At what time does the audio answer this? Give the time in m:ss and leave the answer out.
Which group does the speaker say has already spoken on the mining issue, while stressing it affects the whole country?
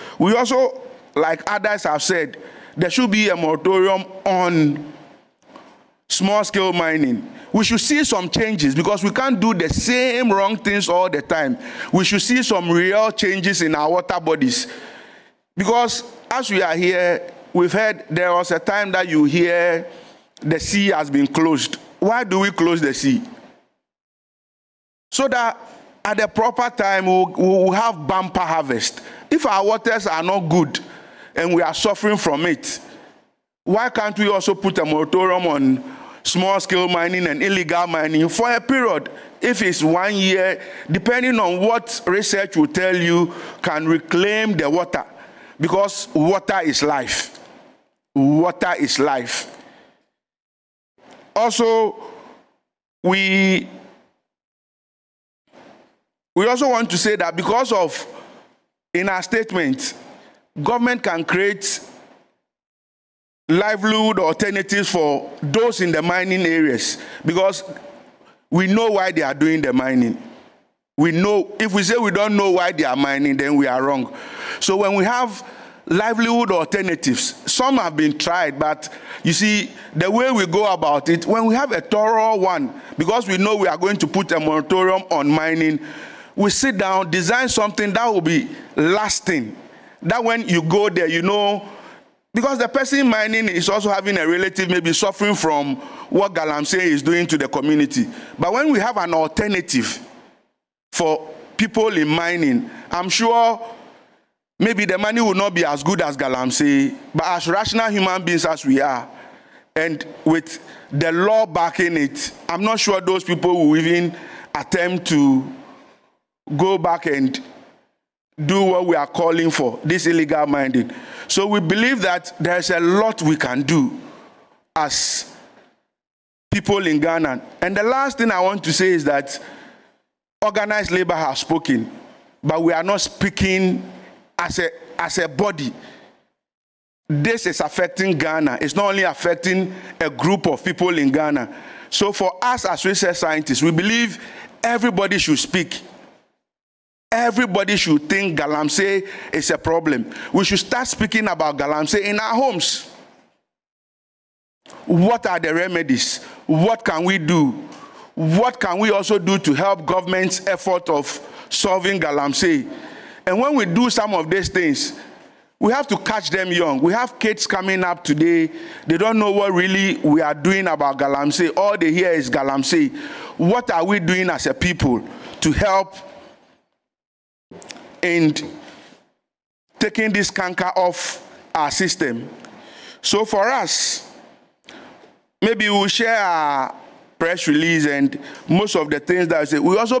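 2:10.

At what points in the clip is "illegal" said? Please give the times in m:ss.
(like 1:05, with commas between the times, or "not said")
0:37, 2:00.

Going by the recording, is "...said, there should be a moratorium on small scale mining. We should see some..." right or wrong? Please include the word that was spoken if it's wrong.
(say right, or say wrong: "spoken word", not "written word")
right.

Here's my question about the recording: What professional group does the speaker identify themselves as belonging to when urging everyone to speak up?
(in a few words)
Research scientists.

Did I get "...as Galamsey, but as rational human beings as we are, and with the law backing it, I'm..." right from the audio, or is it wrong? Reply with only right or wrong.
right.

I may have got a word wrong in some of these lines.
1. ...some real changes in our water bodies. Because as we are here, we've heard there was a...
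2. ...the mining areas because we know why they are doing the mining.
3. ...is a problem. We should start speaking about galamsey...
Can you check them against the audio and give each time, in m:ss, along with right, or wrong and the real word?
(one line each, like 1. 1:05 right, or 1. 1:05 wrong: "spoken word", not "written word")
1. 0:12 right
2. 1:05 right
3. 2:29 right.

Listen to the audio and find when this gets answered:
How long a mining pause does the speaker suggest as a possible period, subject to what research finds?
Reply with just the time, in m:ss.
0:39.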